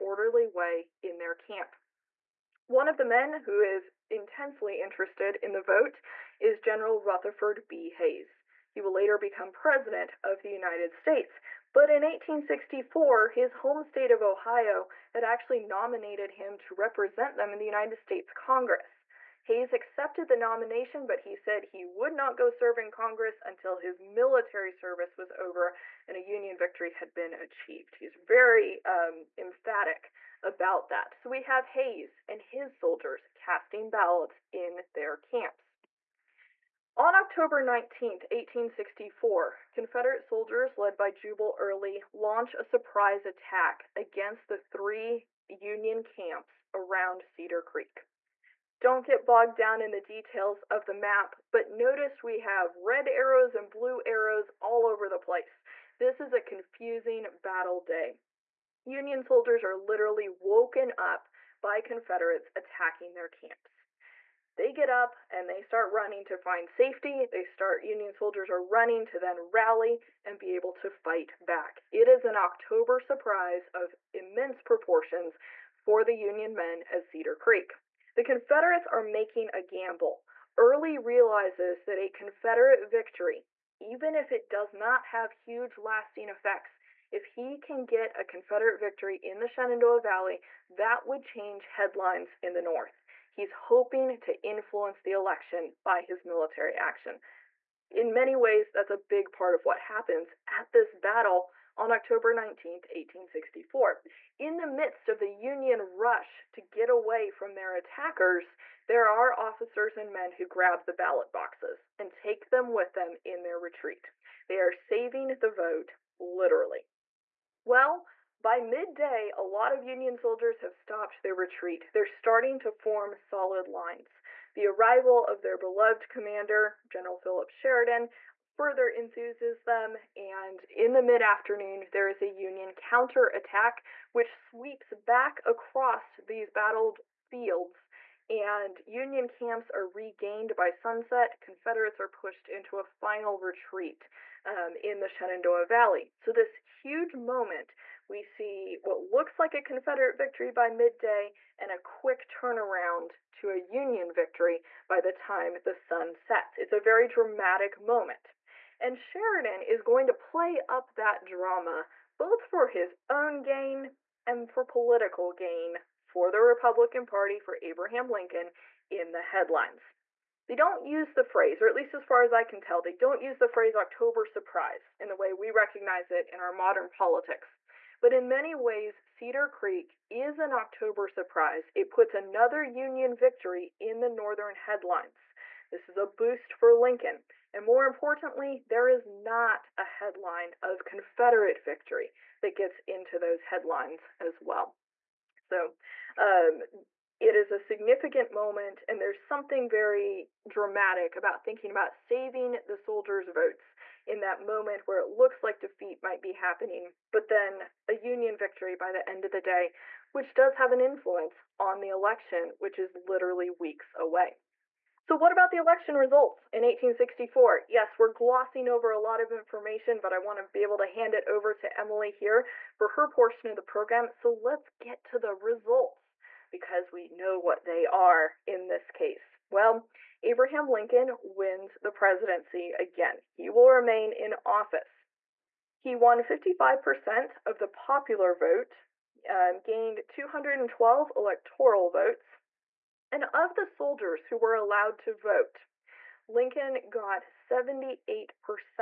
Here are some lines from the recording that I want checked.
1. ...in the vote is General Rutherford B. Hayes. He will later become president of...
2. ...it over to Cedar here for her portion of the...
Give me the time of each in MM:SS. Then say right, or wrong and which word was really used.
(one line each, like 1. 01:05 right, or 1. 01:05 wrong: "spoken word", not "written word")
1. 00:05 right
2. 03:41 wrong: "Emily", not "Cedar".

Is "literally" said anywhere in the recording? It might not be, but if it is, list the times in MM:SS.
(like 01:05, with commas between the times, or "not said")
00:59, 01:56, 03:33.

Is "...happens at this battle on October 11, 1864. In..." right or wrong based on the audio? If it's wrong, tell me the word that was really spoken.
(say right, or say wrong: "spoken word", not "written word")
wrong: "19", not "11".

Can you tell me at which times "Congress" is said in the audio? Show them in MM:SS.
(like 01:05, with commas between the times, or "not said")
00:18, 00:22.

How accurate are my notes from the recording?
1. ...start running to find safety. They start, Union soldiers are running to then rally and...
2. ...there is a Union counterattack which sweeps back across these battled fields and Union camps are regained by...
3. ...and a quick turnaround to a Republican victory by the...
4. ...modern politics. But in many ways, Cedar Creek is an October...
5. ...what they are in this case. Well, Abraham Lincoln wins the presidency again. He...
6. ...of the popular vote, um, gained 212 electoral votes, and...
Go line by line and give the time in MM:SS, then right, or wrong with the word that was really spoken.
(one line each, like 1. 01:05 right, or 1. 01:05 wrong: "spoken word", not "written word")
1. 01:05 right
2. 02:11 right
3. 02:31 wrong: "Union", not "Republican"
4. 02:56 right
5. 03:47 right
6. 03:57 right.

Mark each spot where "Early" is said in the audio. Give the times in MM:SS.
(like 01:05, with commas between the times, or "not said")
00:41, 01:20.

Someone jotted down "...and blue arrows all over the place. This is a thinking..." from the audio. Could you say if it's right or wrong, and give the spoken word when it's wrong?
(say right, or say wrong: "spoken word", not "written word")
wrong: "confusing", not "thinking".